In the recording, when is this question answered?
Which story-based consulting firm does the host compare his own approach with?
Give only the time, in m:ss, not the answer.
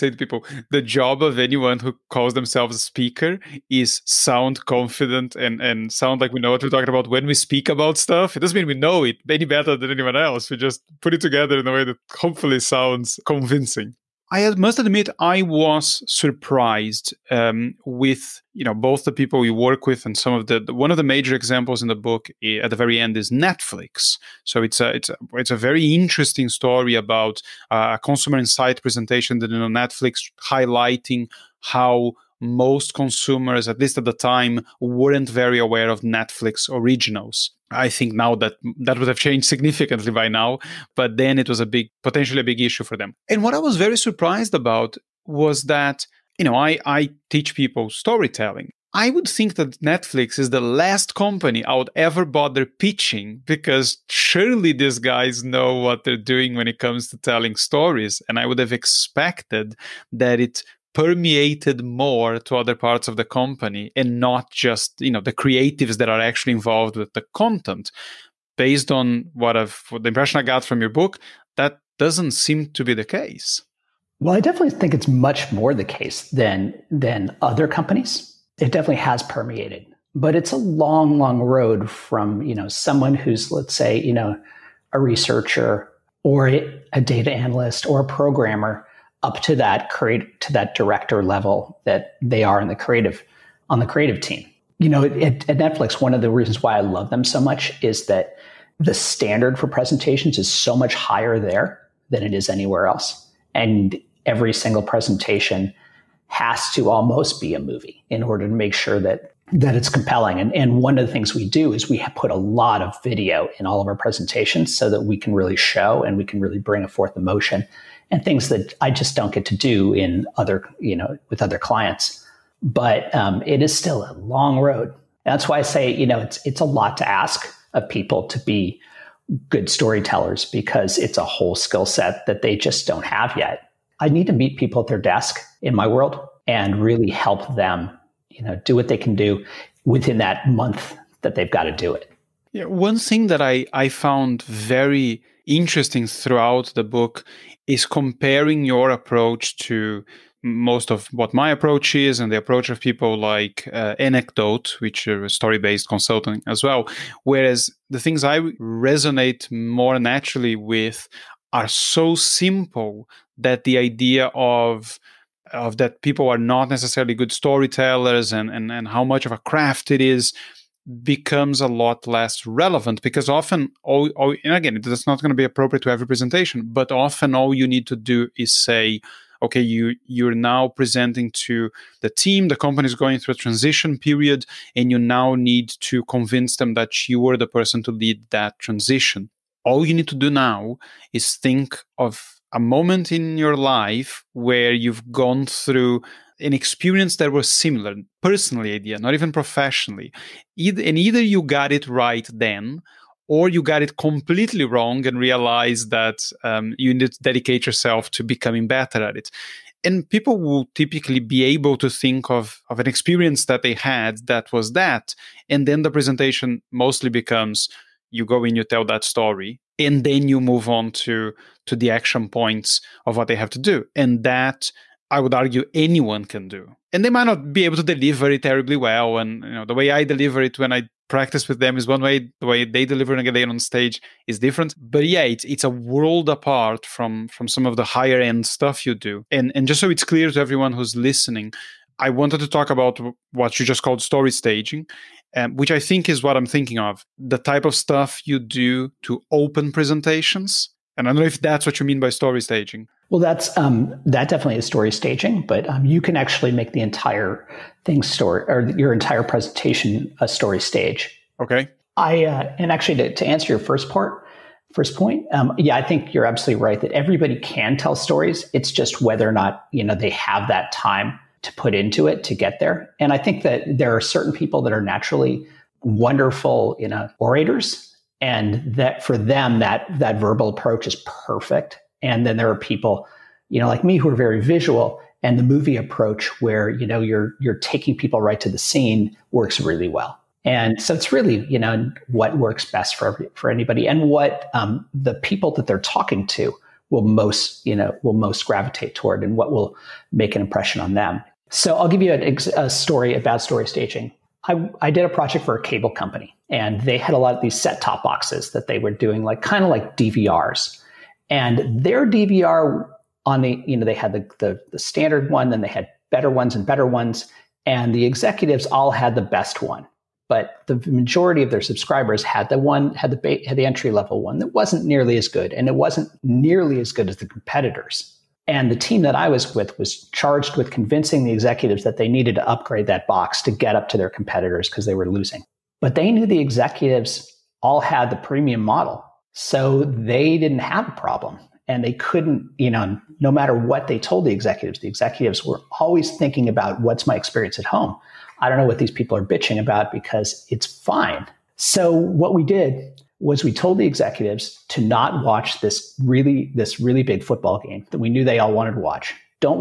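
2:33.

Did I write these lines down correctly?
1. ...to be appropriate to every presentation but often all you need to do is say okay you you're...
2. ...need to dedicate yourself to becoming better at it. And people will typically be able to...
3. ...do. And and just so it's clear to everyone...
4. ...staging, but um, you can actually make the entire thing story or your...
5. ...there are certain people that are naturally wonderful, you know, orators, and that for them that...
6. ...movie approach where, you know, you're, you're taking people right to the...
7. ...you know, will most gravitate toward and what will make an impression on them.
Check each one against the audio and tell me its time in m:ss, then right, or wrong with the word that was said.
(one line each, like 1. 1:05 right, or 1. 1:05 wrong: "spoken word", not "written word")
1. 2:55 right
2. 3:26 right
3. 3:58 right
4. 4:14 right
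5. 4:33 right
6. 4:45 right
7. 4:57 right.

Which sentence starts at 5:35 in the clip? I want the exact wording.
But they knew the executives all had the premium model.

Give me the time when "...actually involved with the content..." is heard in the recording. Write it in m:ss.
1:06.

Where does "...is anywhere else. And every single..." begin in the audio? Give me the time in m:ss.
1:42.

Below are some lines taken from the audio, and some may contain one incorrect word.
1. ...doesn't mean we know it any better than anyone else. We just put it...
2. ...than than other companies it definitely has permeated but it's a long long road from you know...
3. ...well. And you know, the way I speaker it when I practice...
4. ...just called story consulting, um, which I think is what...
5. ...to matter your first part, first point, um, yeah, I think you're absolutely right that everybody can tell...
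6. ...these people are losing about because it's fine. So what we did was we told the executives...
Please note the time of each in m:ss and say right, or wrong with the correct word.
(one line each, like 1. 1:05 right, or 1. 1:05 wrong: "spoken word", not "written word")
1. 0:08 right
2. 1:16 right
3. 3:48 wrong: "deliver", not "speaker"
4. 4:03 wrong: "staging", not "consulting"
5. 4:23 wrong: "answer", not "matter"
6. 5:48 wrong: "bitching", not "losing".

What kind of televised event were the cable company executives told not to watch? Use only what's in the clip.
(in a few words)
football game.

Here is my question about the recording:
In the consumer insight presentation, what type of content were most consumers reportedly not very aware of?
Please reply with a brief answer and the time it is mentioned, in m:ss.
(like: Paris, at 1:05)
Netflix originals, at 0:36.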